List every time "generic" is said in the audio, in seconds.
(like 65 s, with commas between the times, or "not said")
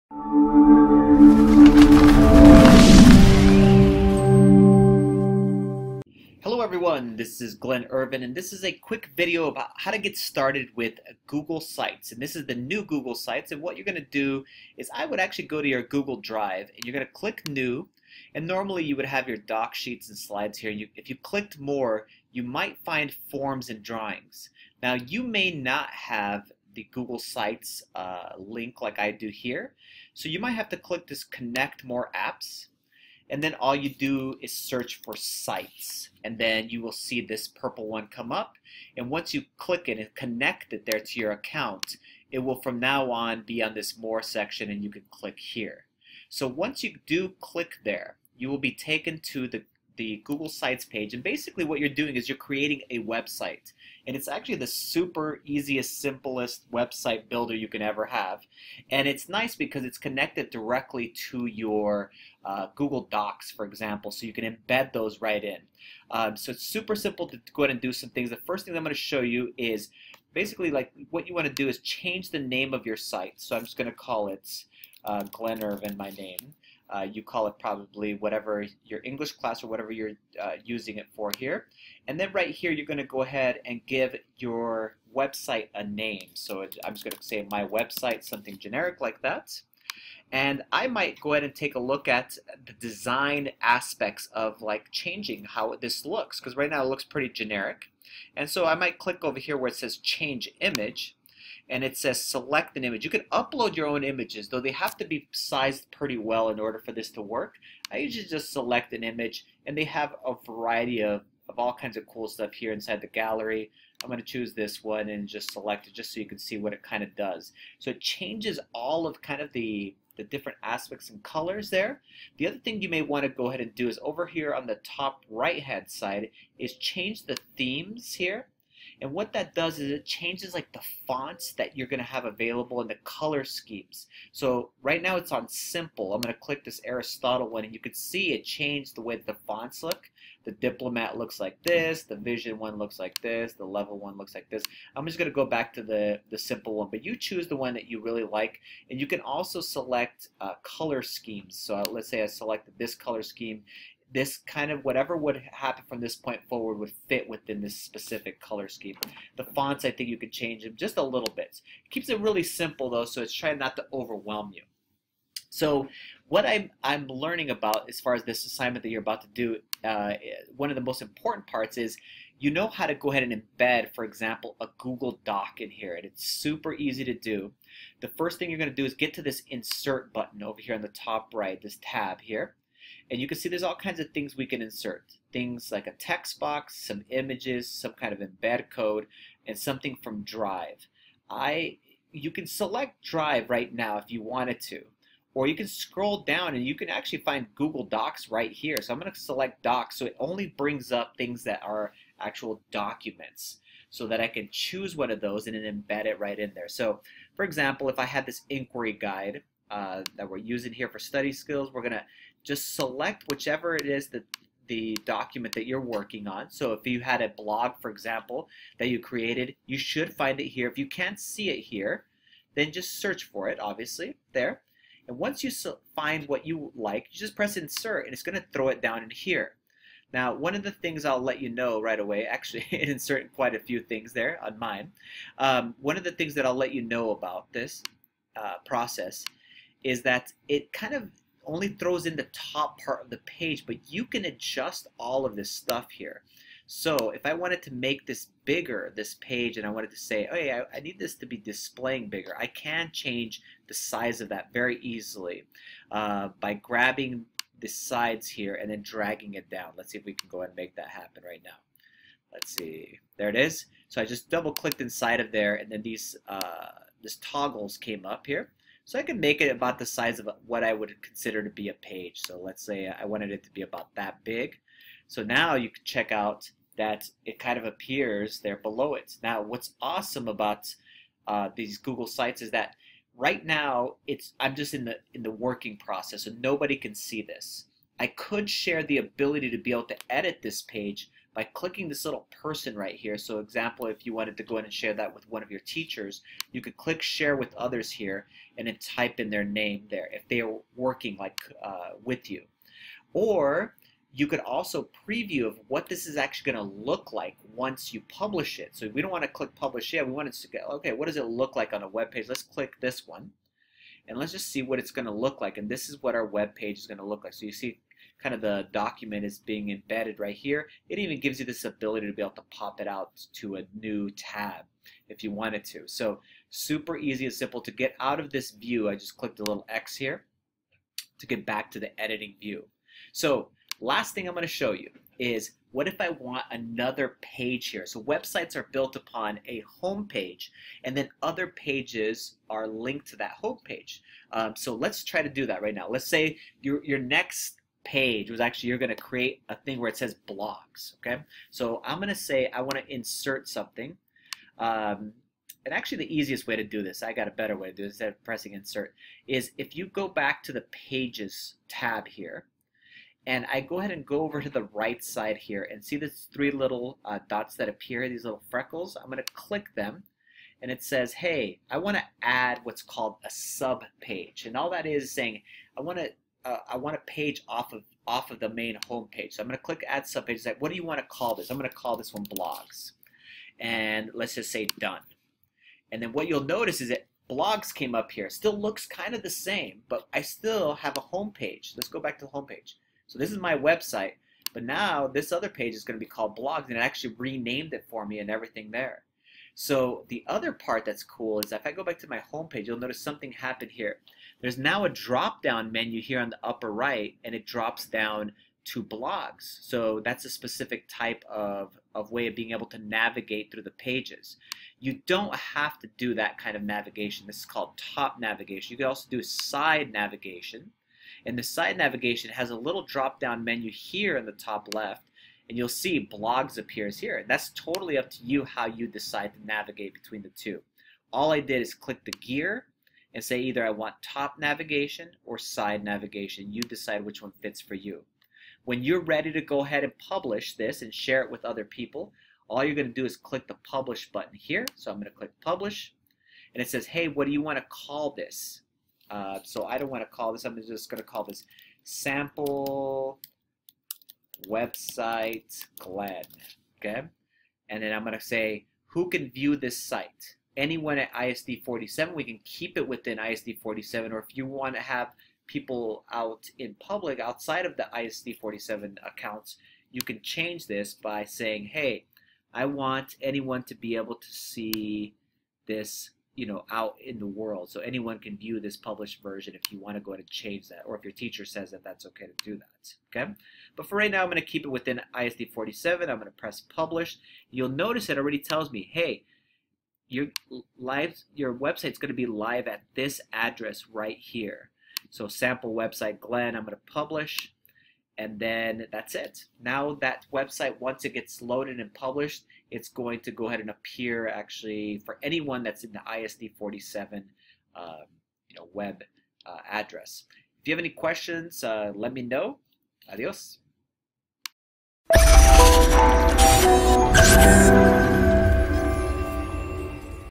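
88 s, 97 s.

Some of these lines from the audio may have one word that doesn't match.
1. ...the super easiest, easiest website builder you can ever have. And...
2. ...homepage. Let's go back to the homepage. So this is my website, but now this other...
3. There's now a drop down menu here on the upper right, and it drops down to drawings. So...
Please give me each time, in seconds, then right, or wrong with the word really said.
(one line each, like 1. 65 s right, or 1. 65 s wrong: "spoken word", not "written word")
1. 54 s wrong: "simplest", not "easiest"
2. 391 s right
3. 404 s wrong: "blogs", not "drawings".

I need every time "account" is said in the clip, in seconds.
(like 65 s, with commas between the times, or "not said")
41 s, 469 s.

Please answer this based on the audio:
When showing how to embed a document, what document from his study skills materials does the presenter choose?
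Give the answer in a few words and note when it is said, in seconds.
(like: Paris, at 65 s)
Inquiry guide, at 208 s.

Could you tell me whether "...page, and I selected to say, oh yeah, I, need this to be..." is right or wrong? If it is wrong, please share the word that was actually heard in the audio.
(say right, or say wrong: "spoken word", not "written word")
wrong: "wanted", not "selected".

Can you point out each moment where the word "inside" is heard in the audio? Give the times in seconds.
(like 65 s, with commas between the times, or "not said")
112 s, 264 s.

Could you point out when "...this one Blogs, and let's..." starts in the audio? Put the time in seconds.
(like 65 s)
381 s.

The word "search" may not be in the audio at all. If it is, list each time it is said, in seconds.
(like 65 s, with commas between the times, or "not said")
34 s, 222 s.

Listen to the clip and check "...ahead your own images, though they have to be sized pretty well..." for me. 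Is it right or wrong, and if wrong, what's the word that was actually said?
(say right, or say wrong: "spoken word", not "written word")
wrong: "upload", not "ahead".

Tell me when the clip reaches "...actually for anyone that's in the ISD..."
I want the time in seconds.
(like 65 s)
504 s.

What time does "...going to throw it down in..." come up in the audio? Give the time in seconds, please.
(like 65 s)
228 s.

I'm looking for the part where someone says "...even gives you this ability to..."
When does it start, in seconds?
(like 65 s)
320 s.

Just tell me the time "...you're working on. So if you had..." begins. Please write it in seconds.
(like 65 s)
215 s.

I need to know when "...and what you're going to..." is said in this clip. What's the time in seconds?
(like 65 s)
13 s.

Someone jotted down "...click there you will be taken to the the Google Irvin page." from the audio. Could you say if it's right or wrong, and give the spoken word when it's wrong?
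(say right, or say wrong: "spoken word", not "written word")
wrong: "Sites", not "Irvin".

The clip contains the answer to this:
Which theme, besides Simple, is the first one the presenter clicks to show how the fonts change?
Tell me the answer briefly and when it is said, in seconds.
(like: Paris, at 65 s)
Aristotle, at 136 s.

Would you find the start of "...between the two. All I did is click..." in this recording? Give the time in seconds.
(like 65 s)
429 s.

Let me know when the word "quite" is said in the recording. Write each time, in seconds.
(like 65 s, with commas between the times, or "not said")
233 s.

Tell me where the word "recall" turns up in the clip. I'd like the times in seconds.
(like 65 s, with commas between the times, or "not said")
not said.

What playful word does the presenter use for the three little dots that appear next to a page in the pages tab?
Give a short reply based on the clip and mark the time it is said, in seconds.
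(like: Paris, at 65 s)
Freckles, at 368 s.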